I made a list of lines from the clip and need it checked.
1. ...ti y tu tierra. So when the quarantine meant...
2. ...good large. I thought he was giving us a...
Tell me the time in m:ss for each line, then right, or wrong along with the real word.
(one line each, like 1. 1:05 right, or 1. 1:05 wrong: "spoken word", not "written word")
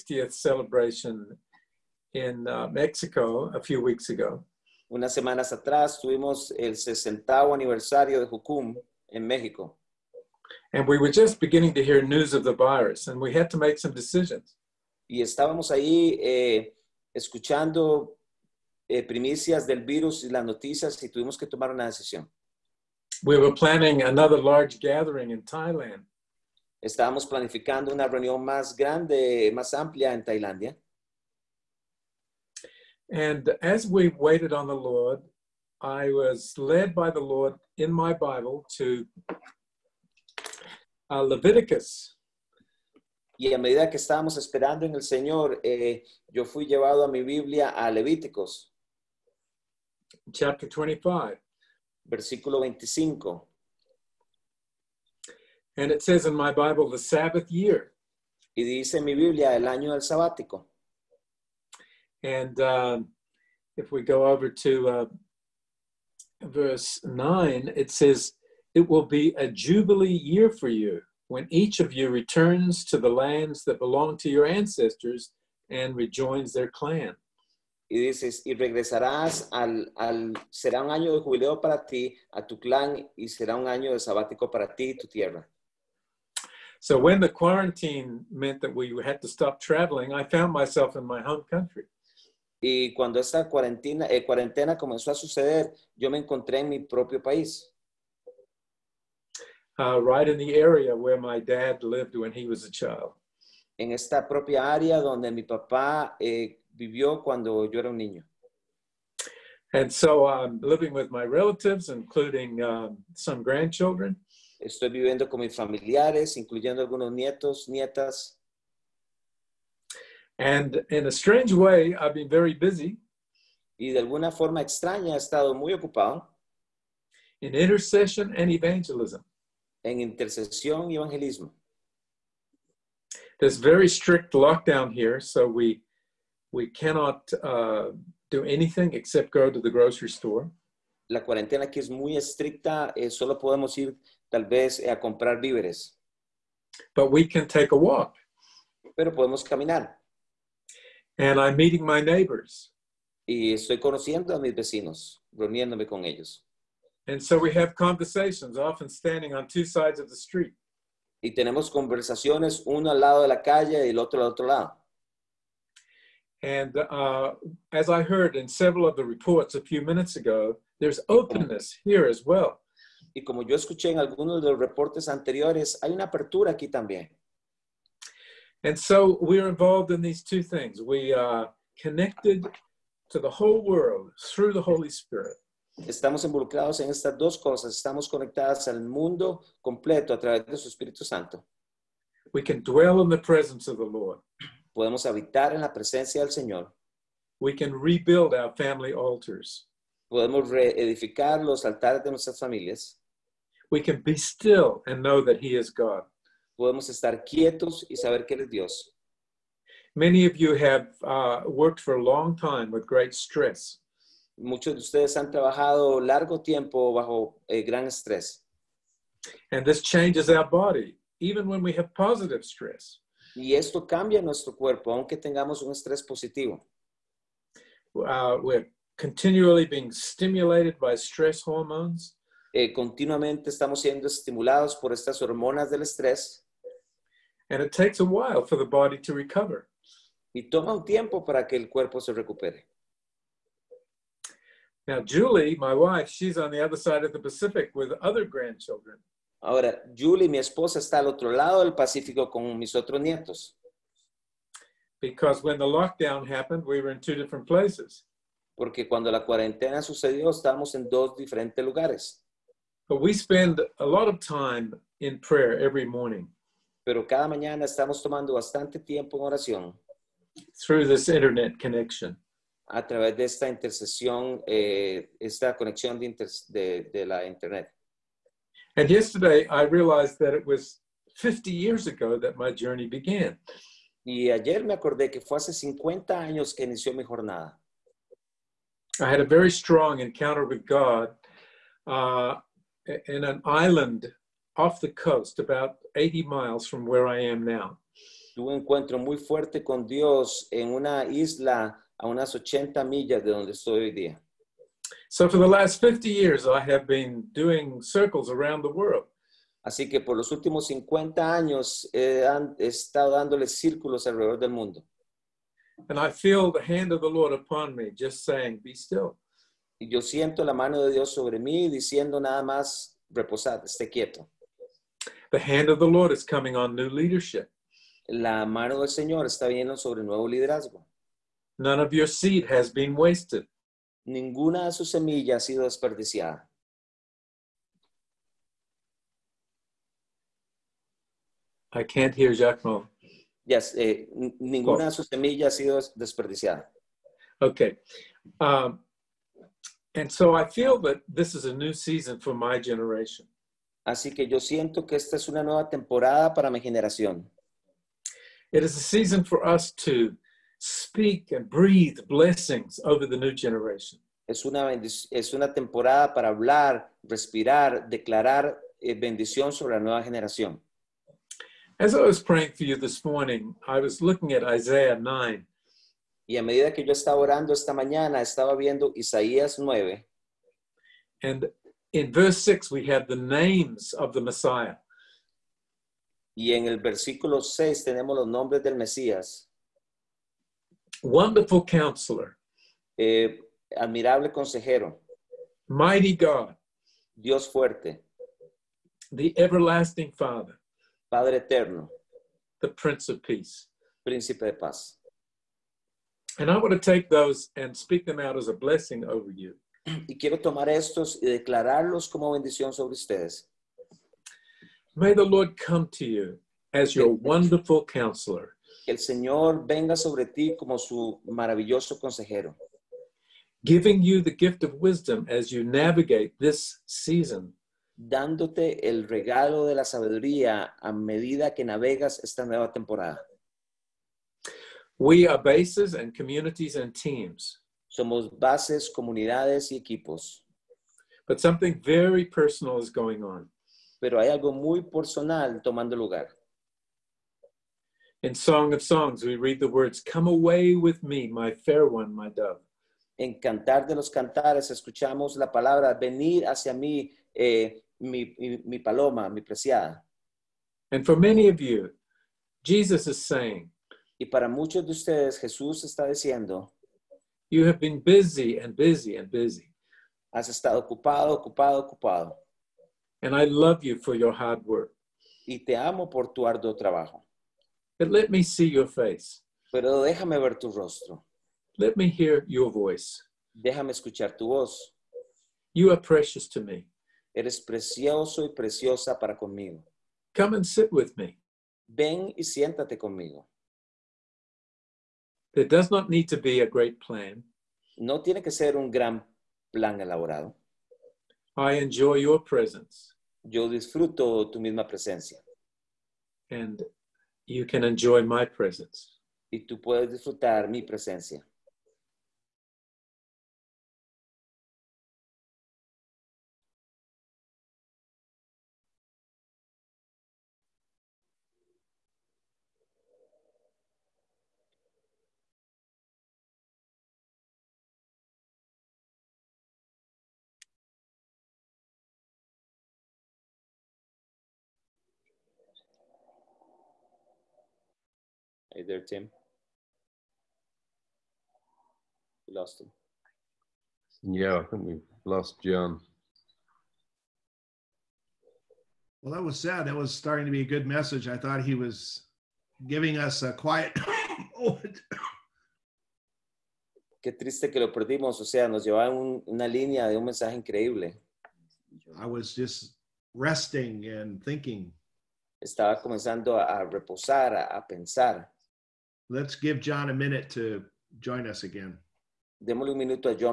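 1. 1:24 right
2. 9:10 wrong: "message", not "large".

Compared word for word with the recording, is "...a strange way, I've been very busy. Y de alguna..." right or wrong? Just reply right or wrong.
right.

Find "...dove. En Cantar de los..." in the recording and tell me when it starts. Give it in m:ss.
7:32.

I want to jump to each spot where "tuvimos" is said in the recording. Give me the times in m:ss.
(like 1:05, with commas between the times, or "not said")
0:06, 0:21.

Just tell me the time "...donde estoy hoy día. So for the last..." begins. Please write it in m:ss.
5:03.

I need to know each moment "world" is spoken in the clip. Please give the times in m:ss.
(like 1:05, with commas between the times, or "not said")
3:03, 5:08.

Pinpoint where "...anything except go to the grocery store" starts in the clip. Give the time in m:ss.
2:18.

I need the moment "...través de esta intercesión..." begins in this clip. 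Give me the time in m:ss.
4:32.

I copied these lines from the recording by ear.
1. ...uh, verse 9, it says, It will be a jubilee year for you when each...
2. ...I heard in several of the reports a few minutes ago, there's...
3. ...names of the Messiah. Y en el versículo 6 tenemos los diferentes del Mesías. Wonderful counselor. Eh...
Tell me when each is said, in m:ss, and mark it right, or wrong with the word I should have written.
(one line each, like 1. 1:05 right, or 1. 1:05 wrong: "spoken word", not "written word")
1. 1:04 right
2. 2:47 right
3. 6:23 wrong: "nombres", not "diferentes".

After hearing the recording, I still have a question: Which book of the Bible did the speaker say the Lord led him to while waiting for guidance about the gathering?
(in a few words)
Leviticus.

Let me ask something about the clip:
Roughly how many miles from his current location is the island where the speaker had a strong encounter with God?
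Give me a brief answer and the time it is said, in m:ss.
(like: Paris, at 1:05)
80, at 4:55.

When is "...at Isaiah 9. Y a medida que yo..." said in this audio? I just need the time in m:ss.
6:14.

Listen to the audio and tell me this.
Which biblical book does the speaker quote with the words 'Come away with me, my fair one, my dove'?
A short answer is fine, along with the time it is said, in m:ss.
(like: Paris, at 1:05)
Song of Songs, at 7:28.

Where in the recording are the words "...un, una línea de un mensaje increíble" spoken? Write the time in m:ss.
9:19.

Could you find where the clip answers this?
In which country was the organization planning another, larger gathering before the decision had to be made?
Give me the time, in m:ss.
0:25.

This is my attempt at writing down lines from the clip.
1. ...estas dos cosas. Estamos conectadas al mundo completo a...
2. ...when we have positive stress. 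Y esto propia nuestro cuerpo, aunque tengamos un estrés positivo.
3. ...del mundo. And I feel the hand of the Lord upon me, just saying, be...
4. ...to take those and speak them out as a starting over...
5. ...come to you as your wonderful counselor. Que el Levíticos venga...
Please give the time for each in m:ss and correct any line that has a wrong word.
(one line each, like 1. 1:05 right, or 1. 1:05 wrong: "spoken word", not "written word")
1. 3:06 right
2. 3:41 wrong: "cambia", not "propia"
3. 5:14 right
4. 6:46 wrong: "blessing", not "starting"
5. 6:55 wrong: "Señor", not "Levíticos".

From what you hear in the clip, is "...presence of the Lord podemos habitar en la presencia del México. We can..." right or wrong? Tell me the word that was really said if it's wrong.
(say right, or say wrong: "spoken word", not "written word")
wrong: "Señor", not "México".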